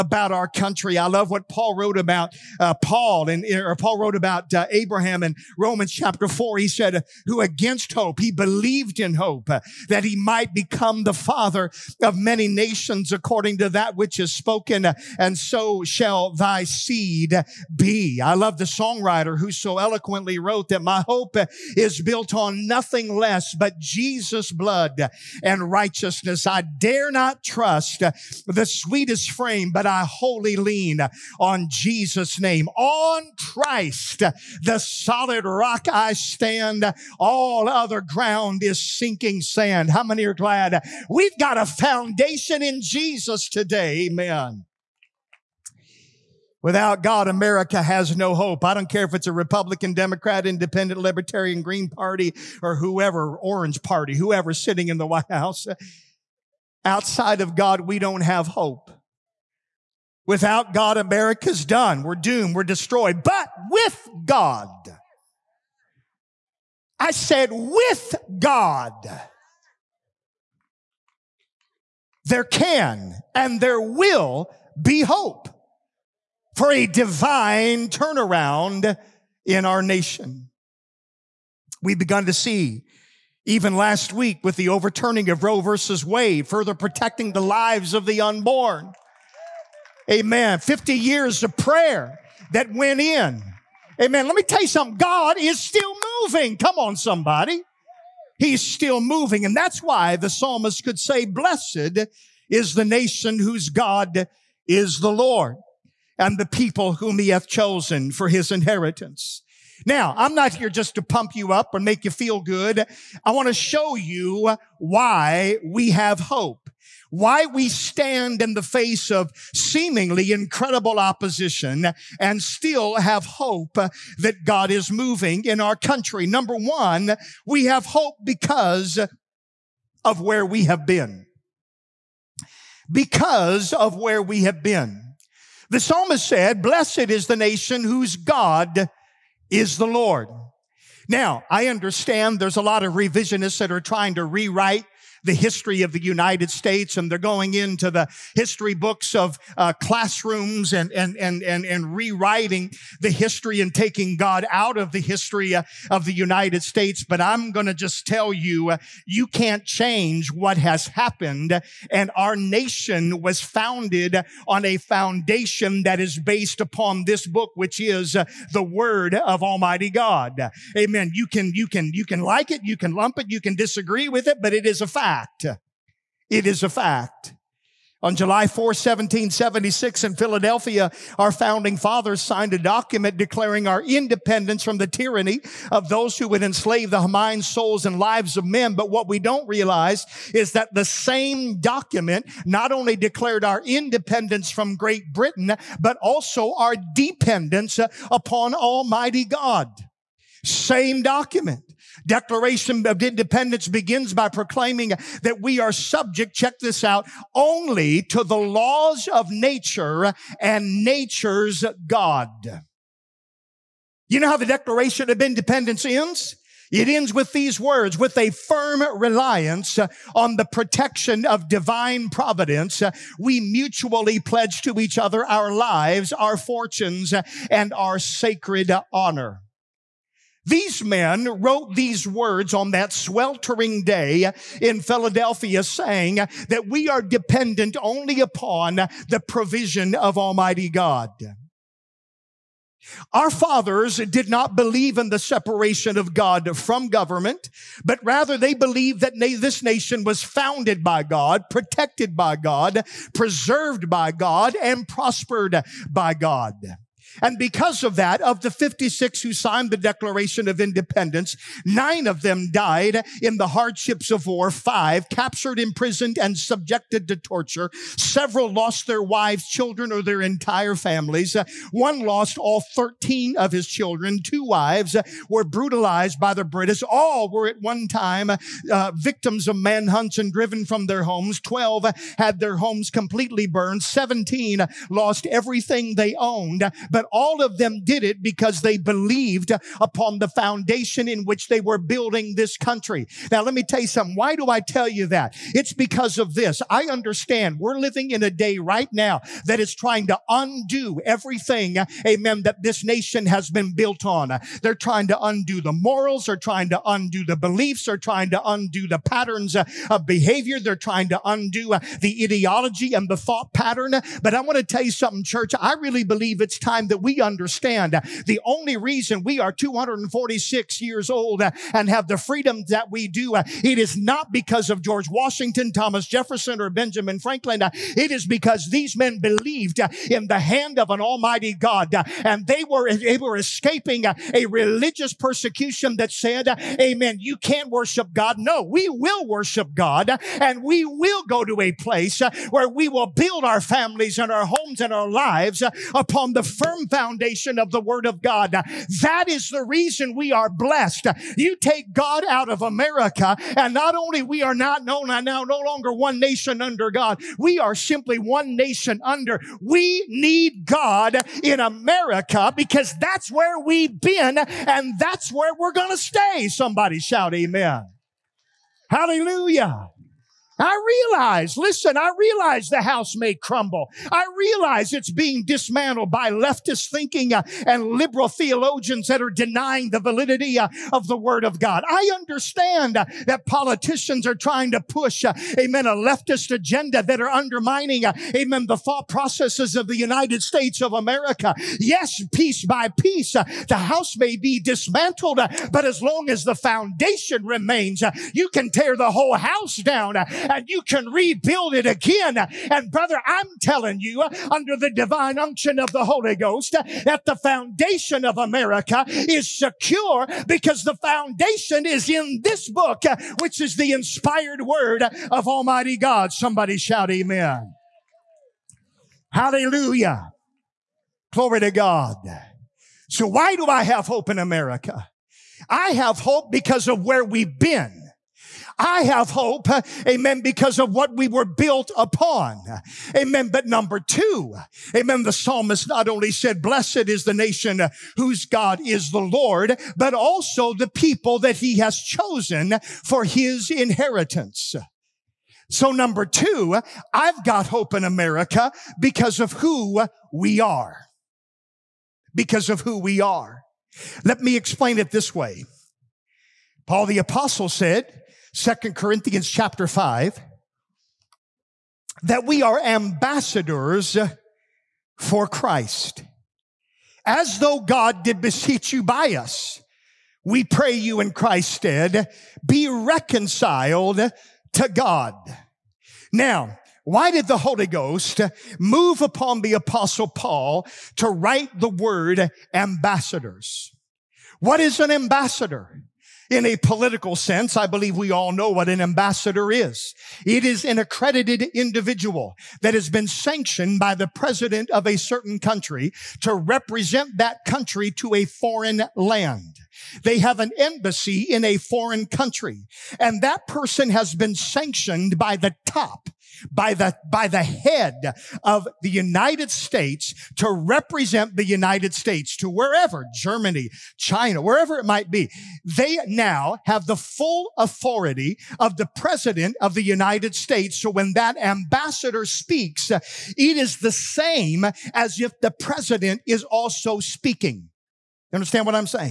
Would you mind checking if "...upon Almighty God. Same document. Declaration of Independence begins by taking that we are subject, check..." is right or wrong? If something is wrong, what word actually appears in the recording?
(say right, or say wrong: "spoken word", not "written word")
wrong: "proclaiming", not "taking".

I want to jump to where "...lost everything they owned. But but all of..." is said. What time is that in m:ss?
4:44.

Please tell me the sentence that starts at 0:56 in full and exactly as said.
Outside of God, we don't have hope.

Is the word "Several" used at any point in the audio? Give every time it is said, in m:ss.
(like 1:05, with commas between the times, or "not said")
4:27.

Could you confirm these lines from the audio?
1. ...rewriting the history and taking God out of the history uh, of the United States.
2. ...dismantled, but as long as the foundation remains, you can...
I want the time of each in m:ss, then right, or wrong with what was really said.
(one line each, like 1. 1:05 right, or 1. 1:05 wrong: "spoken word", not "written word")
1. 2:31 right
2. 6:34 right.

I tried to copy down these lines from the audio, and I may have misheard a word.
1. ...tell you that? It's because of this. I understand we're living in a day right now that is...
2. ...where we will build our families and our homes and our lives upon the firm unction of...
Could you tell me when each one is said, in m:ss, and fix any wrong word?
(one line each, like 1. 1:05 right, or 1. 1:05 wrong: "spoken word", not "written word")
1. 4:54 right
2. 5:42 wrong: "foundation", not "unction".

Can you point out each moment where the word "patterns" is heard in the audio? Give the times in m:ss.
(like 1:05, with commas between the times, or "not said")
5:09, 5:13.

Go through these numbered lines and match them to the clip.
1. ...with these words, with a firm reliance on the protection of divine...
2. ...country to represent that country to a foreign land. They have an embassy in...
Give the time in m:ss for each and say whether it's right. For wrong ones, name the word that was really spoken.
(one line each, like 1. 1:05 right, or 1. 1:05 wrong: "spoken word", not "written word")
1. 3:37 right
2. 8:15 right.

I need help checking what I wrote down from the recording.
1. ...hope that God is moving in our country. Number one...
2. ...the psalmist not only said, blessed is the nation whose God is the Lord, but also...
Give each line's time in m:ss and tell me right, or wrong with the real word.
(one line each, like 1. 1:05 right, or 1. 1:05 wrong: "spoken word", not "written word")
1. 2:03 right
2. 7:15 right.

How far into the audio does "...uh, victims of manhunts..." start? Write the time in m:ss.
4:38.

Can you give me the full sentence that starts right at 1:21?
We've begun to see even last week with the overturning of Roe versus Wade, further protecting the lives of the unborn.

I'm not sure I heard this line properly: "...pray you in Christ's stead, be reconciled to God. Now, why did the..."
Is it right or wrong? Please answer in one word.
right.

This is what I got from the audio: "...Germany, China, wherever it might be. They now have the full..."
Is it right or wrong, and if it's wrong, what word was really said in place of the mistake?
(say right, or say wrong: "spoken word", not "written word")
right.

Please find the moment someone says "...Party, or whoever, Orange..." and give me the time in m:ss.
0:51.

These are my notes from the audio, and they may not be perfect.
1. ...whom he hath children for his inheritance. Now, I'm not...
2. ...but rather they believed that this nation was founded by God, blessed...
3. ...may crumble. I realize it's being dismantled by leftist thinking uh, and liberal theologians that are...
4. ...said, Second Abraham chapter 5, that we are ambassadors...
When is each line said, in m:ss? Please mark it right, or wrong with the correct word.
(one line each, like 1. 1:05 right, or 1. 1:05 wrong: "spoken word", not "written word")
1. 1:46 wrong: "chosen", not "children"
2. 4:07 wrong: "protected", not "blessed"
3. 6:13 right
4. 7:37 wrong: "Corinthians", not "Abraham".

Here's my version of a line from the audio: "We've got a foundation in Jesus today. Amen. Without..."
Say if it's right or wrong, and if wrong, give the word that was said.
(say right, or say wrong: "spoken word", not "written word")
right.